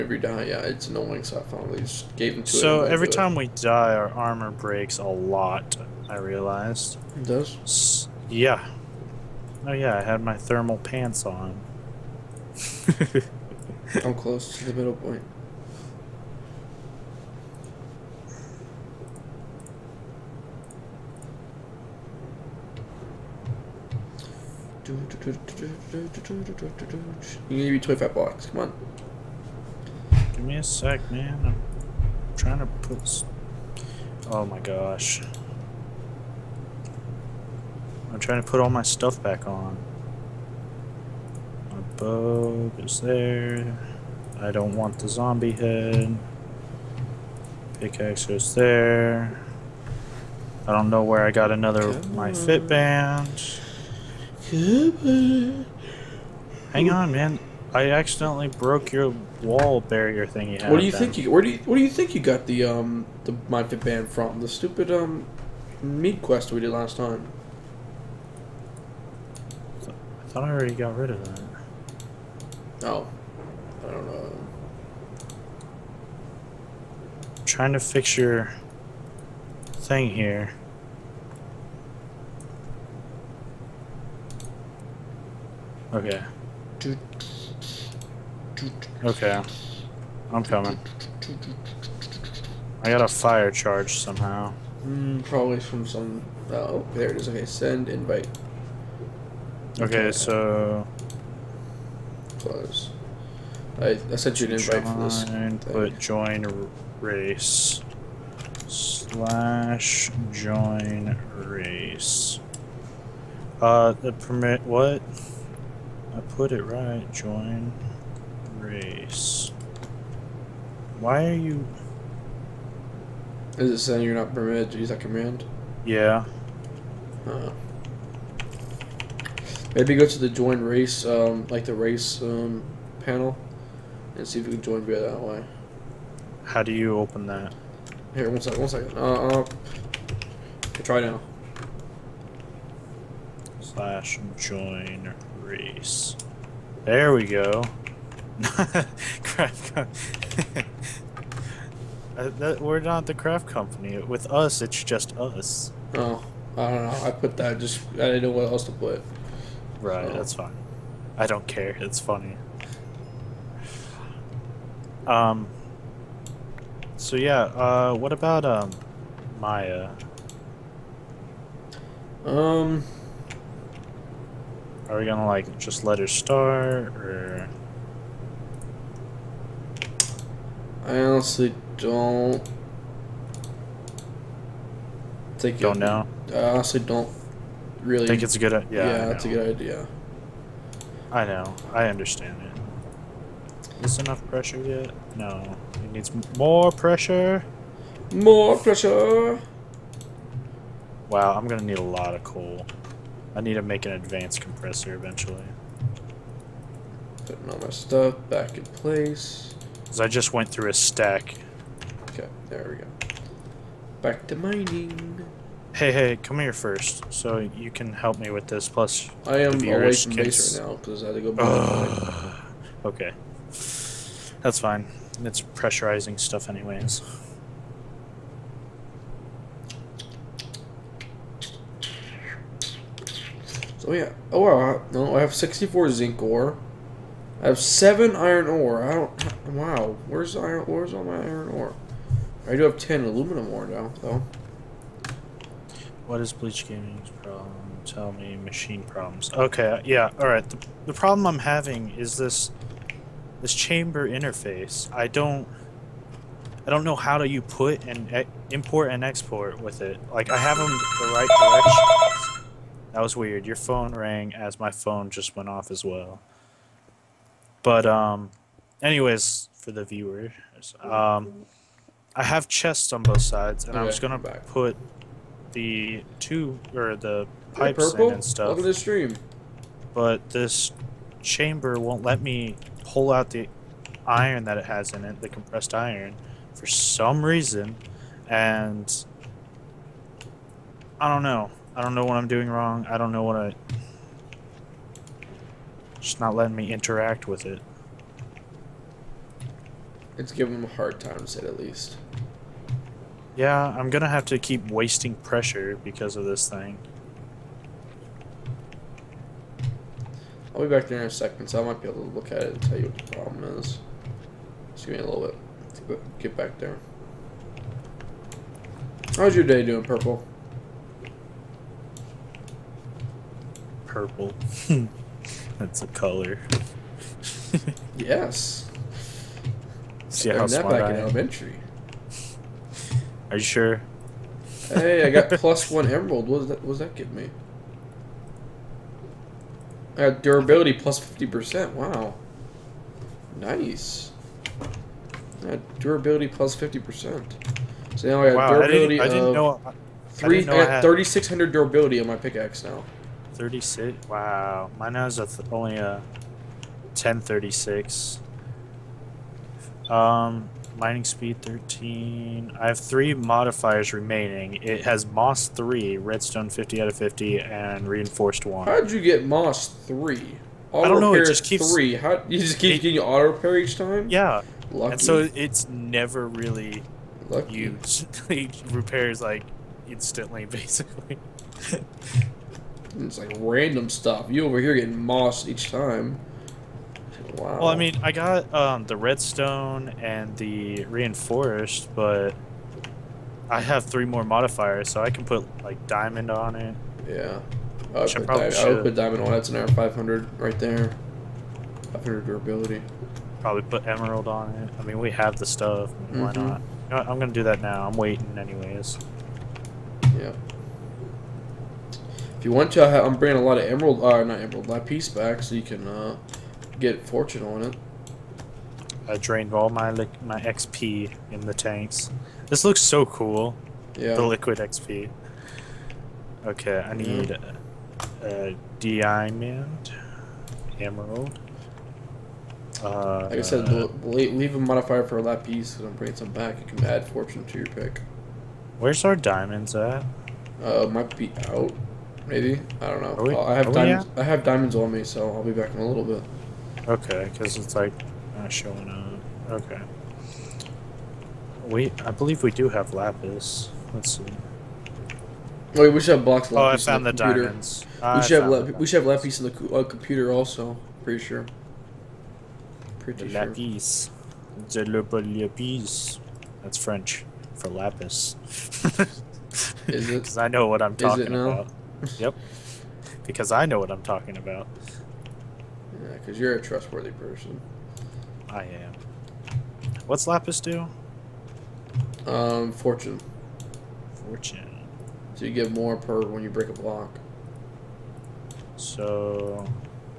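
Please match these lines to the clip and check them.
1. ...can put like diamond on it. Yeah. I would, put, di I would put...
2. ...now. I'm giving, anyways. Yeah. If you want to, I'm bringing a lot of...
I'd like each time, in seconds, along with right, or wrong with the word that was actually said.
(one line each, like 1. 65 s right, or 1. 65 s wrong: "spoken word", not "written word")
1. 395 s right
2. 407 s wrong: "waiting", not "giving".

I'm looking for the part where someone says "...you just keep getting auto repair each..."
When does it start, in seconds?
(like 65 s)
372 s.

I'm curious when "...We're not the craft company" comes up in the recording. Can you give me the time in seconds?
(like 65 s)
152 s.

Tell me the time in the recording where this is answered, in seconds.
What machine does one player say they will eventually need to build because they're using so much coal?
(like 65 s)
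203 s.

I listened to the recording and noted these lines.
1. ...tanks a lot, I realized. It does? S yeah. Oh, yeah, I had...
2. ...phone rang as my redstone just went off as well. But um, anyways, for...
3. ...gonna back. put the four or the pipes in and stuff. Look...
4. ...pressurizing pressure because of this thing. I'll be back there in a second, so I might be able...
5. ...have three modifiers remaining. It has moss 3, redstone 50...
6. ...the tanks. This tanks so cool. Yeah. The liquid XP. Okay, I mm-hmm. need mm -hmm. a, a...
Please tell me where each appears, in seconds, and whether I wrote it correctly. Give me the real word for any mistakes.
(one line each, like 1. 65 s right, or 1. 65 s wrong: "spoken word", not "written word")
1. 4 s wrong: "breaks", not "tanks"
2. 263 s wrong: "phone", not "redstone"
3. 273 s wrong: "two", not "four"
4. 304 s wrong: "wasting", not "pressurizing"
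5. 362 s right
6. 421 s wrong: "looks", not "tanks".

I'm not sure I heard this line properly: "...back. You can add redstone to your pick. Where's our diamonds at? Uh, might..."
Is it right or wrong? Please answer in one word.
wrong.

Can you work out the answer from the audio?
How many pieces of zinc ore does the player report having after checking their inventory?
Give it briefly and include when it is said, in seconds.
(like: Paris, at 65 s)
64, at 235 s.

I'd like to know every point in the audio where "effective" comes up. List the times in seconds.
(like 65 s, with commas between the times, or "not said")
not said.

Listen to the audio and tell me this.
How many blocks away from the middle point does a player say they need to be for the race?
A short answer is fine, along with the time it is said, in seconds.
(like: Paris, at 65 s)
25, at 27 s.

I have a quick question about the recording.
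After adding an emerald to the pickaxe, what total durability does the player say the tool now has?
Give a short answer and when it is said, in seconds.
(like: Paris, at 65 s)
3,600, at 350 s.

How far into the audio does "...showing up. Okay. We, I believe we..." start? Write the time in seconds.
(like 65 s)
448 s.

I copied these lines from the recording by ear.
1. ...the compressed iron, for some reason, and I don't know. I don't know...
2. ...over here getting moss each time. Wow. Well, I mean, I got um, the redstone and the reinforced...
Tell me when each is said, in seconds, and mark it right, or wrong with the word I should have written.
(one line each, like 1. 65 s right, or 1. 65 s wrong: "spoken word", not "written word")
1. 285 s right
2. 384 s right.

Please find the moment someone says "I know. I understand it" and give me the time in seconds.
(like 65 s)
191 s.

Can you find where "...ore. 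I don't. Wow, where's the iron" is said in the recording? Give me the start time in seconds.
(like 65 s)
238 s.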